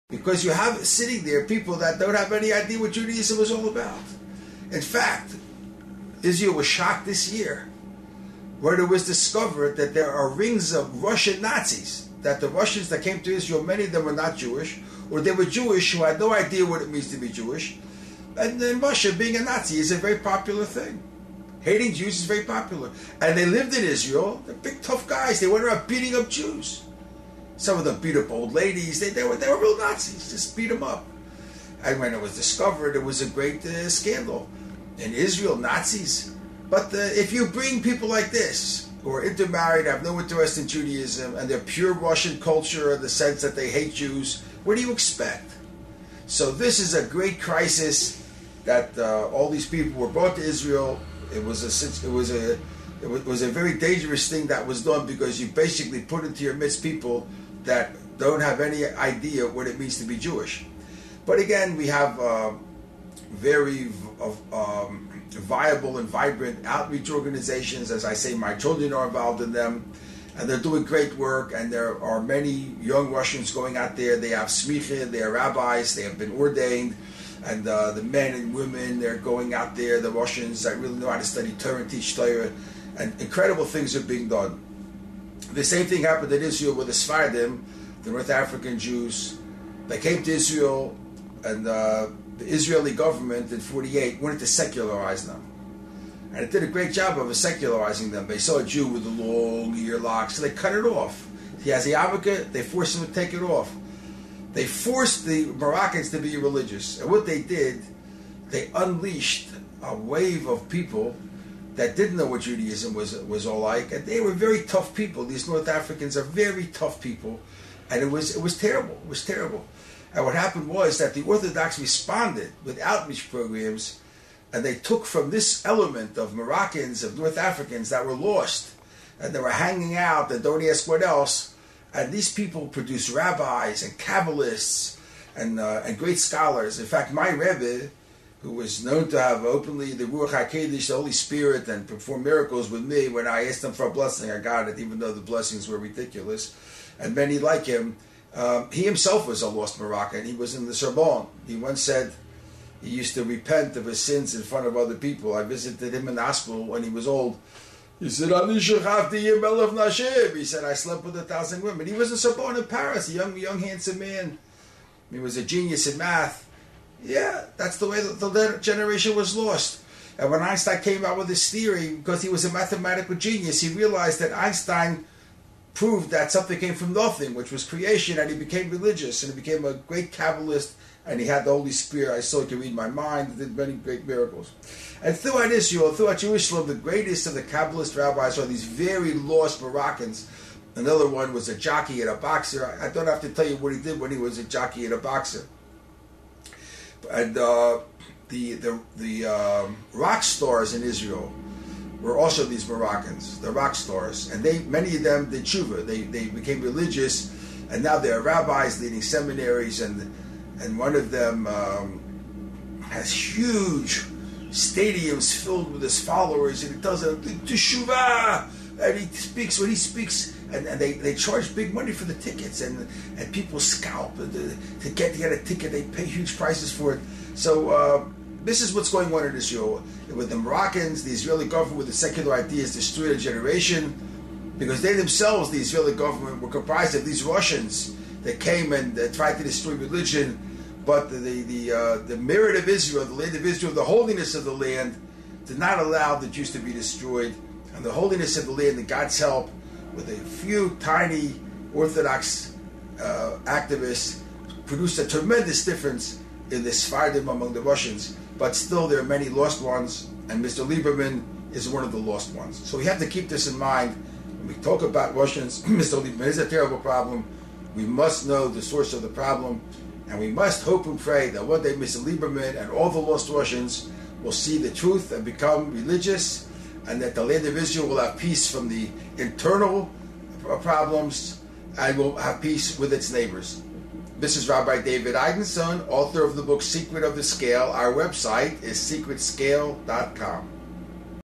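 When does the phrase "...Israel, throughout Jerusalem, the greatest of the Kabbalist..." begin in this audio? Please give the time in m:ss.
3:05.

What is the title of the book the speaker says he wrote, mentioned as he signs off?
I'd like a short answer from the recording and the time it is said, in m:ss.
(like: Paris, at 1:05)
Secret of the Scale, at 4:46.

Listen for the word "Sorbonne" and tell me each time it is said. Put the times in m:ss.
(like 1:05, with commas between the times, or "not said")
2:30, 2:42.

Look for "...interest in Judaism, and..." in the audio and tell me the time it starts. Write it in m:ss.
0:40.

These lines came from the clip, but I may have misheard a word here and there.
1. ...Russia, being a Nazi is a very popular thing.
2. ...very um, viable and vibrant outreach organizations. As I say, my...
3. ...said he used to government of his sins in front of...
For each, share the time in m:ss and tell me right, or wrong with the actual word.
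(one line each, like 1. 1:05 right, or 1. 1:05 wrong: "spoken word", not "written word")
1. 0:18 right
2. 1:03 right
3. 2:31 wrong: "repent", not "government".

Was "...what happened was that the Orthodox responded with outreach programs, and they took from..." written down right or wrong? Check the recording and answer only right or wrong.
right.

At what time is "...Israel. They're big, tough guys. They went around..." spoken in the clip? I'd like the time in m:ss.
0:23.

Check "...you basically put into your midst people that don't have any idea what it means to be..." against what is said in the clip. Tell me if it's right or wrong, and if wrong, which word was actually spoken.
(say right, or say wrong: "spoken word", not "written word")
right.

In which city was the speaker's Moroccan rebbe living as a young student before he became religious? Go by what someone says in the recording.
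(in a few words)
Paris.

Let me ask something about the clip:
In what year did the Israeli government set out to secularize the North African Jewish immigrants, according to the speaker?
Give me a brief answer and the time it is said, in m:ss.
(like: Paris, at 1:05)
1948, at 1:33.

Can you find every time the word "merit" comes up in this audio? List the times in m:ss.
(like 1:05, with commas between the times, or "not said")
4:02.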